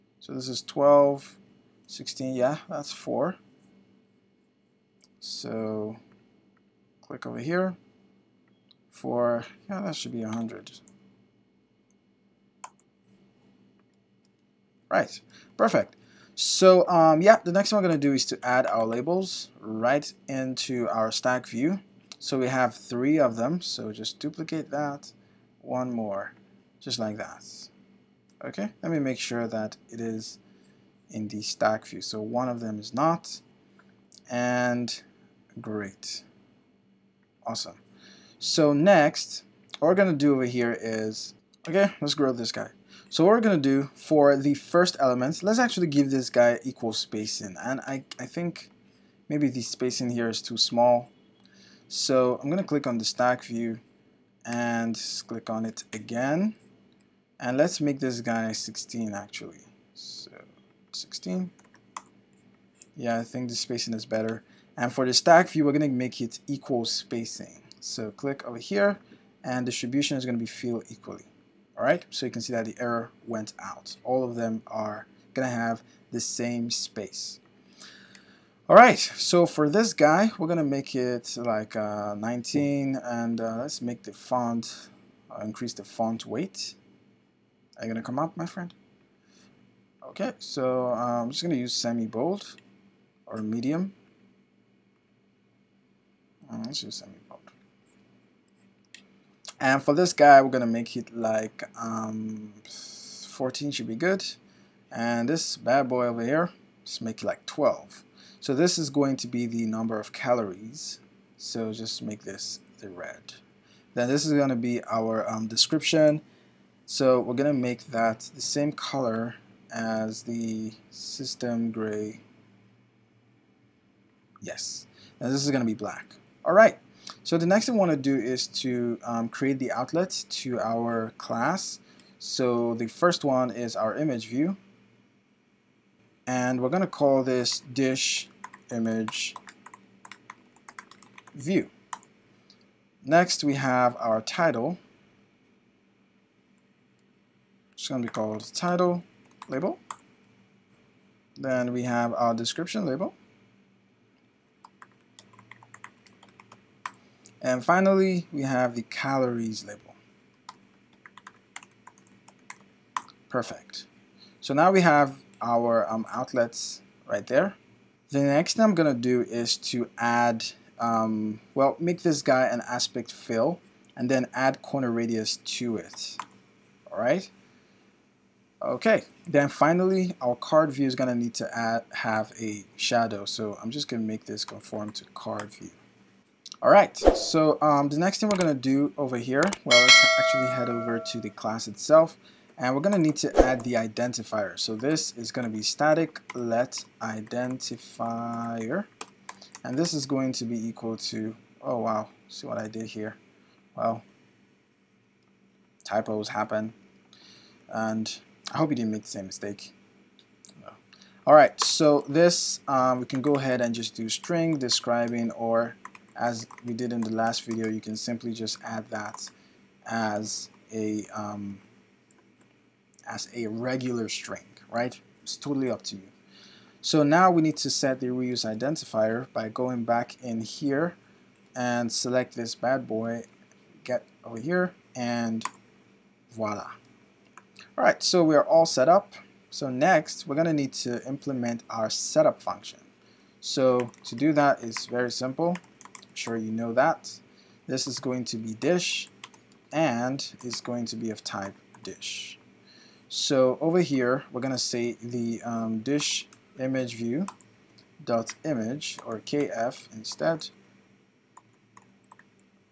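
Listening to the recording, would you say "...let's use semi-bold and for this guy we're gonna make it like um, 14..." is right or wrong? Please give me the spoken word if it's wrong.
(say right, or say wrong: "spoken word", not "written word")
right.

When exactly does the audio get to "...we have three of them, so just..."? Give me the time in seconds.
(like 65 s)
22 s.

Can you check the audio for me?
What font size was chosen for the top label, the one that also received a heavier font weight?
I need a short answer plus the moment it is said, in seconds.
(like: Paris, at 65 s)
19, at 82 s.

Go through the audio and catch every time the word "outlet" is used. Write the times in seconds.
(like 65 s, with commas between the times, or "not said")
129 s, 166 s.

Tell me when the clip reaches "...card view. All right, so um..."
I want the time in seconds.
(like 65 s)
185 s.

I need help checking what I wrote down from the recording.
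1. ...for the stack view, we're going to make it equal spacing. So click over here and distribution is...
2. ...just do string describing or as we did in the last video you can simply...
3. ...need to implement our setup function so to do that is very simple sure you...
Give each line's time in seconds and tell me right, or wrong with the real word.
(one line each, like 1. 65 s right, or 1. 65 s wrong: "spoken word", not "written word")
1. 64 s right
2. 213 s right
3. 240 s right.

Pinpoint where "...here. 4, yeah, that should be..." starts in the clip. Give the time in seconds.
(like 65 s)
7 s.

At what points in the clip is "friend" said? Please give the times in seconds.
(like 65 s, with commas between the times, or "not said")
88 s.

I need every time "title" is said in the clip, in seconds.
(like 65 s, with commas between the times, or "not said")
144 s, 148 s.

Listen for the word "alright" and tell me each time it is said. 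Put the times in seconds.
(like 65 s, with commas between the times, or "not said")
126 s, 237 s.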